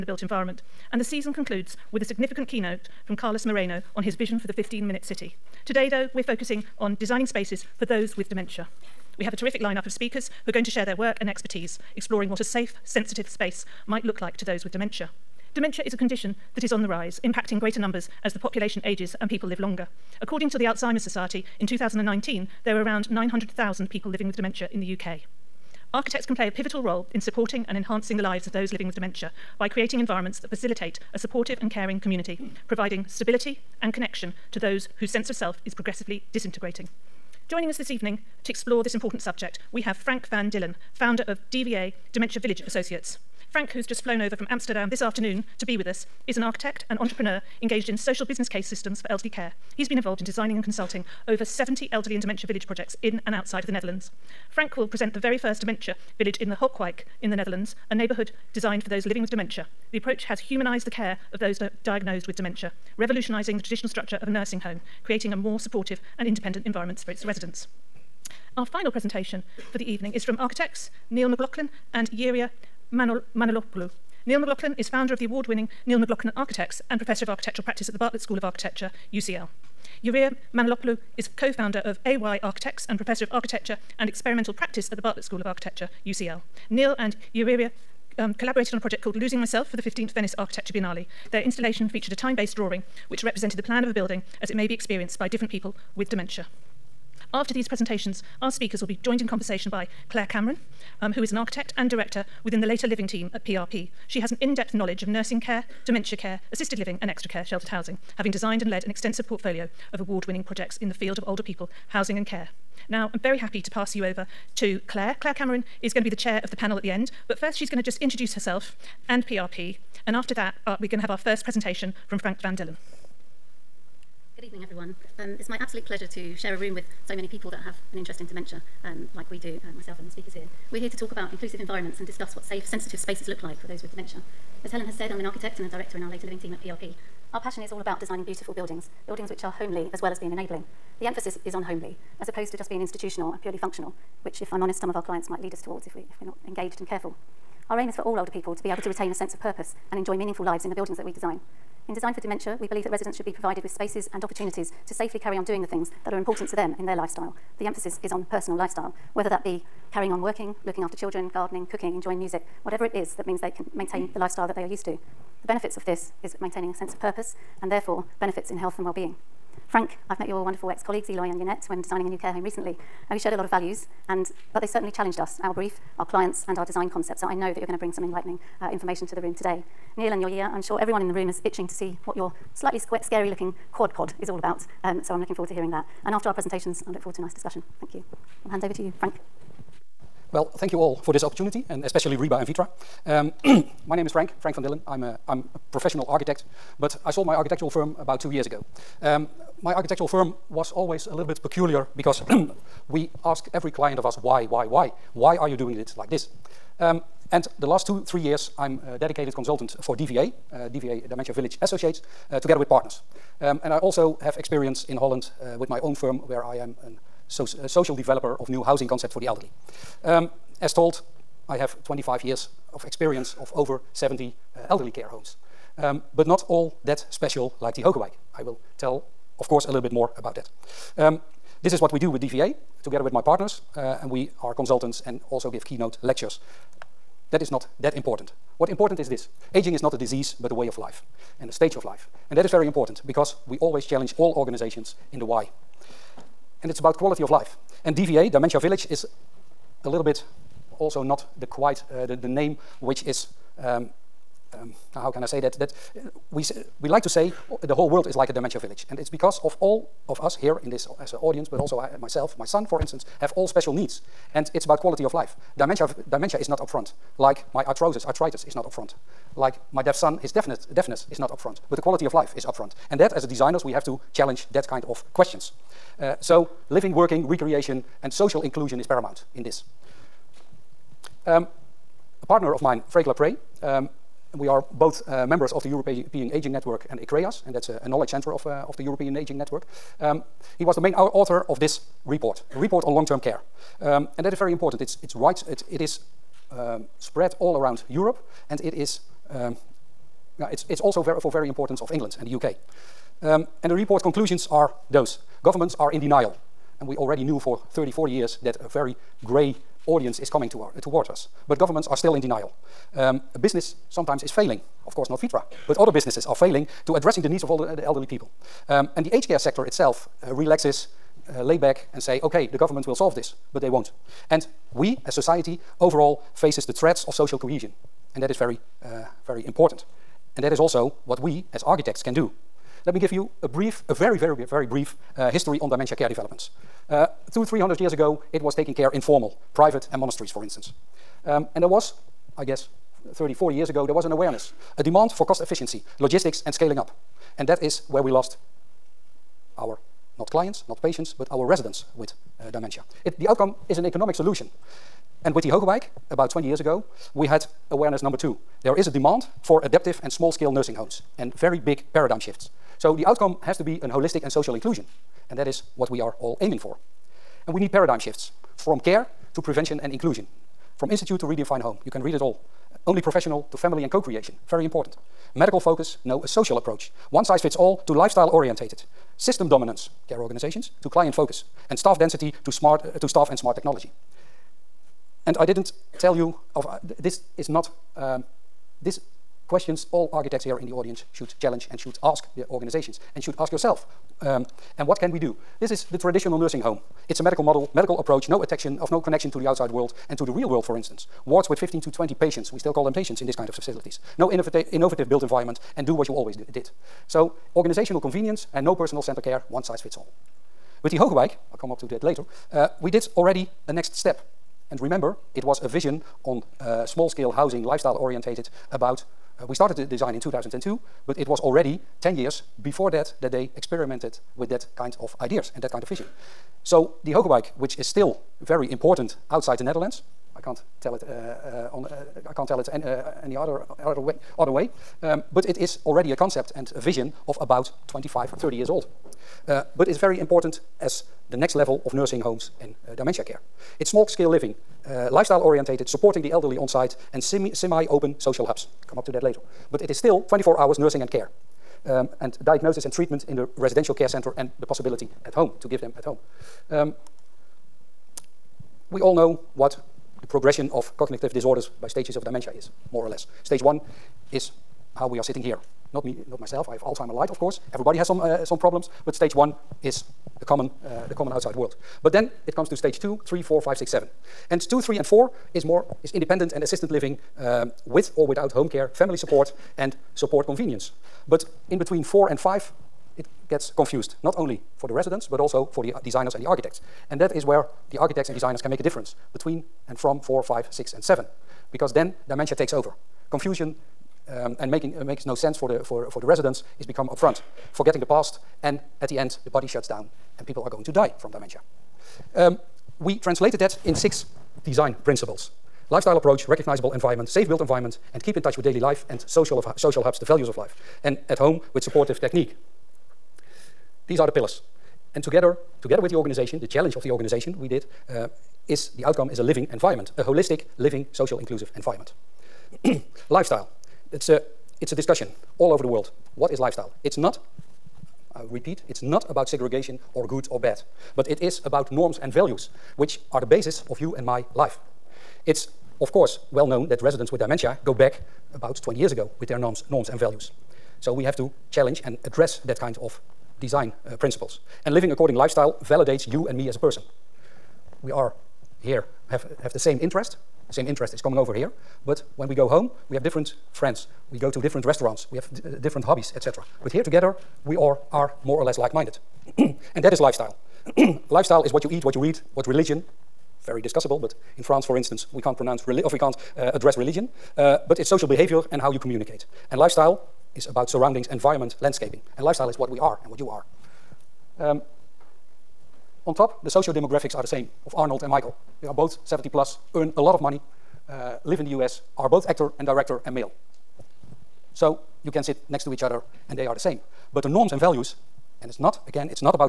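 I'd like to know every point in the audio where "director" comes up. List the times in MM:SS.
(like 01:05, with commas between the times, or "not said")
01:41, 02:15, 09:42.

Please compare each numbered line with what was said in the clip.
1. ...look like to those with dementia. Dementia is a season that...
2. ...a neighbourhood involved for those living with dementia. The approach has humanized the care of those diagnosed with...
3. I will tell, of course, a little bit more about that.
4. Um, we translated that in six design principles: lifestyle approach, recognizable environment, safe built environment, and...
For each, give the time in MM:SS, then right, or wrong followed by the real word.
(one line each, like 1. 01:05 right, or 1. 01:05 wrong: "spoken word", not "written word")
1. 00:14 wrong: "condition", not "season"
2. 00:57 wrong: "designed", not "involved"
3. 03:48 right
4. 08:22 right.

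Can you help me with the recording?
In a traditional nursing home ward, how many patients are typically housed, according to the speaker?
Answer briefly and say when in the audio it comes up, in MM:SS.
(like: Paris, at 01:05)
15 to 20, at 06:41.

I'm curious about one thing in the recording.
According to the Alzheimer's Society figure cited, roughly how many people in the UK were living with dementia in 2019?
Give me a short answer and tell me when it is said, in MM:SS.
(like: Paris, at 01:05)
900,000, at 00:23.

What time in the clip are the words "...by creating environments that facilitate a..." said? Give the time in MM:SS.
00:29.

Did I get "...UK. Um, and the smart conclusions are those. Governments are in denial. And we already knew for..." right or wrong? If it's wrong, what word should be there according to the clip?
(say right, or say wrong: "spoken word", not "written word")
wrong: "report", not "smart".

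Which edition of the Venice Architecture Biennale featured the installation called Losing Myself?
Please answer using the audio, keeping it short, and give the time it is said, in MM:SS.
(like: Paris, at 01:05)
15th, at 01:29.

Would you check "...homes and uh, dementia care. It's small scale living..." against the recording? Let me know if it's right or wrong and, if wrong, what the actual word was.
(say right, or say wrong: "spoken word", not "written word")
right.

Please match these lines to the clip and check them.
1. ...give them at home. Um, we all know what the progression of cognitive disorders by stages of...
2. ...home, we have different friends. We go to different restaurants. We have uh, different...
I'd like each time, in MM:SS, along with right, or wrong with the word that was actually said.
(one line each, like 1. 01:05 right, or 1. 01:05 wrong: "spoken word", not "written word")
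1. 07:35 right
2. 09:12 right.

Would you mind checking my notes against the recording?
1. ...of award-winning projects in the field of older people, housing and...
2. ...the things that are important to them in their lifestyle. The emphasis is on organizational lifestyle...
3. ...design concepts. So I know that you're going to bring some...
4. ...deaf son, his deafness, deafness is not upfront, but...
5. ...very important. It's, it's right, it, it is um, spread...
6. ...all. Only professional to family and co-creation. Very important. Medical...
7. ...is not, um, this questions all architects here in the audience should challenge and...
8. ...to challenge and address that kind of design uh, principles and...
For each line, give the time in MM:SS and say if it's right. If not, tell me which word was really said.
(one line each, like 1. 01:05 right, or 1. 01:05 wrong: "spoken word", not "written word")
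1. 01:49 right
2. 02:35 wrong: "personal", not "organizational"
3. 02:56 right
4. 04:29 right
5. 04:54 right
6. 06:12 right
7. 06:27 right
8. 09:01 right.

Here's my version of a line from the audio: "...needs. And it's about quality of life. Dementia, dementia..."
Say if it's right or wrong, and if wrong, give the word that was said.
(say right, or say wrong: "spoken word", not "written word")
right.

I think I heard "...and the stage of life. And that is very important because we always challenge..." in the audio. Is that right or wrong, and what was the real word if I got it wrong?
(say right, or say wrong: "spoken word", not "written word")
right.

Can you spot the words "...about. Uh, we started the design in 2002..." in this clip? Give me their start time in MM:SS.
06:58.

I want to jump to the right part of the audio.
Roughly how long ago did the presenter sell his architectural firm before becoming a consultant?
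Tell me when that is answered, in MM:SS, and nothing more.
03:17.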